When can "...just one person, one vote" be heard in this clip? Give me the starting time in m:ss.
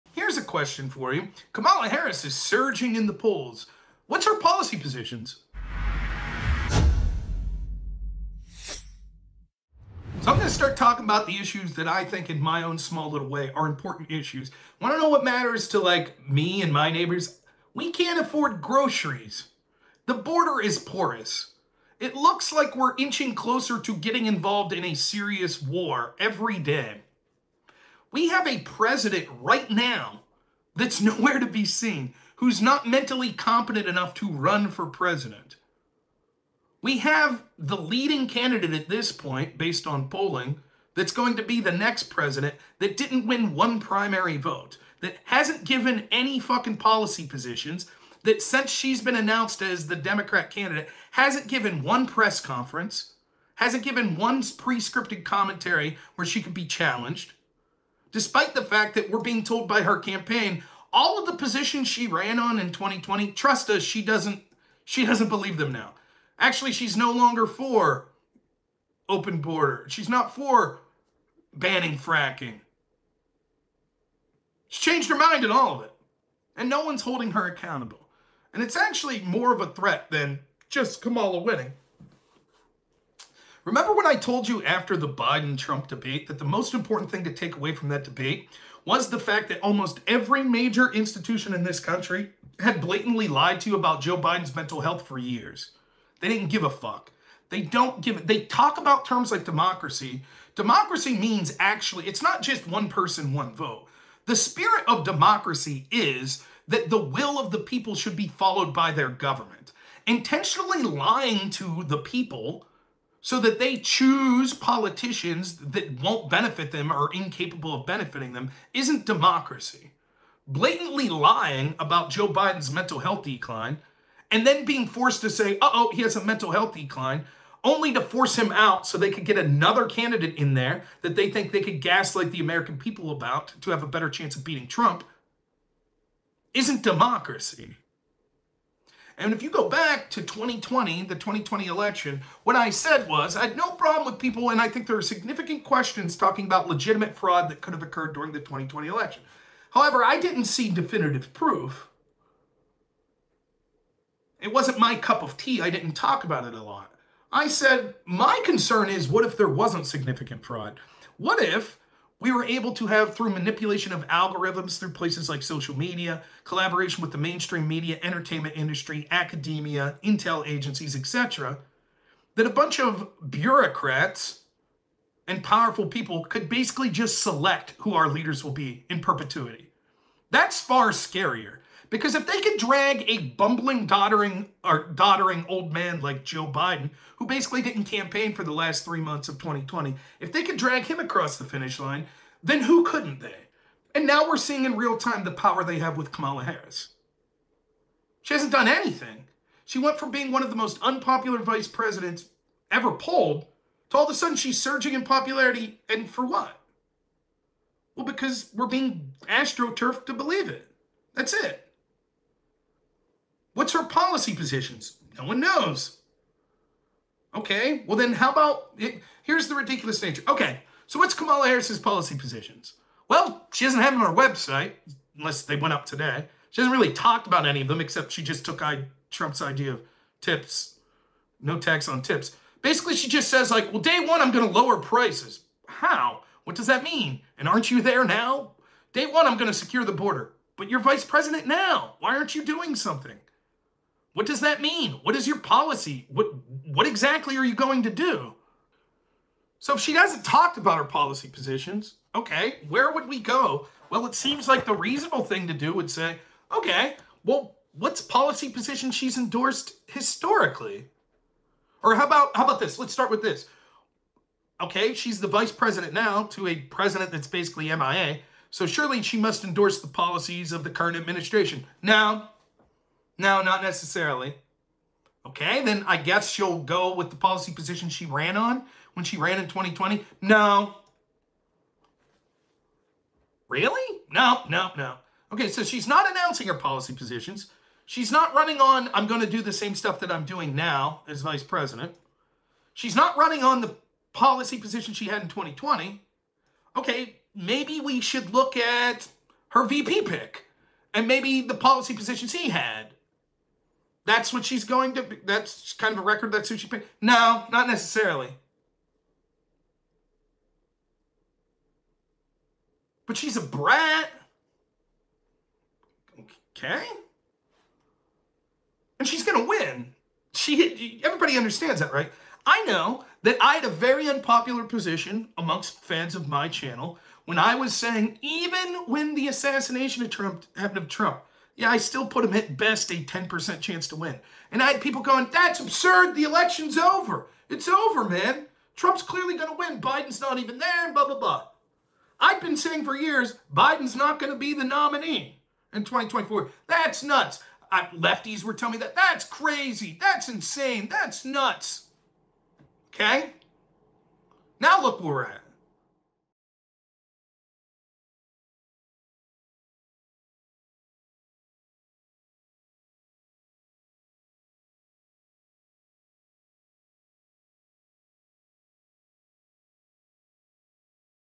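1:42.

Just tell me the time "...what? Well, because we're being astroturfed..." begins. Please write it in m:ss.
3:26.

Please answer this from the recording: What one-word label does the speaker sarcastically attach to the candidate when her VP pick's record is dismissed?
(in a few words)
Brat.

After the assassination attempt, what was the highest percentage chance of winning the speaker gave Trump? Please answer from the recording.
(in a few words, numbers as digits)
10%.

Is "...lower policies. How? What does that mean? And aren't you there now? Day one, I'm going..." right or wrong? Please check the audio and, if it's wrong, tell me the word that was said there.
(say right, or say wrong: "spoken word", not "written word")
wrong: "prices", not "policies".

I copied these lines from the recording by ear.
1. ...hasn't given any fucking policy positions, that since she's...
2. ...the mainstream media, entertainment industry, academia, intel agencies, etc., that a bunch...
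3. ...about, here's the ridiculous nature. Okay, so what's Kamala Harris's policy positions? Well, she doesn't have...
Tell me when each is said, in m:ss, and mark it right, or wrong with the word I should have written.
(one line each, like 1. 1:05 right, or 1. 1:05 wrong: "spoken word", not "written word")
1. 0:45 right
2. 2:47 right
3. 3:38 right.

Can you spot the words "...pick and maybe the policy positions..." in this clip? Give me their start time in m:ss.
5:00.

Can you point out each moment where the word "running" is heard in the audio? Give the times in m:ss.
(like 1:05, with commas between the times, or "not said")
4:48, 4:53.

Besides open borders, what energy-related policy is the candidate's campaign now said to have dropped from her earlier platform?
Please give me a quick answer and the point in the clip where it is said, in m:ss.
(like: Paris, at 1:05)
Banning fracking, at 1:11.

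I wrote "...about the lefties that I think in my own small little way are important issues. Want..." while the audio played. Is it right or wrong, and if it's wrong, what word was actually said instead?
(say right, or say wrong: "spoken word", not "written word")
wrong: "issues", not "lefties".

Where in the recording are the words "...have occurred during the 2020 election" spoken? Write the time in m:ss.
2:27.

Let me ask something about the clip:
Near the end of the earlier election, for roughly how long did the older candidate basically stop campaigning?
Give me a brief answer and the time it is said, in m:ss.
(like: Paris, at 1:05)
3 months, at 3:08.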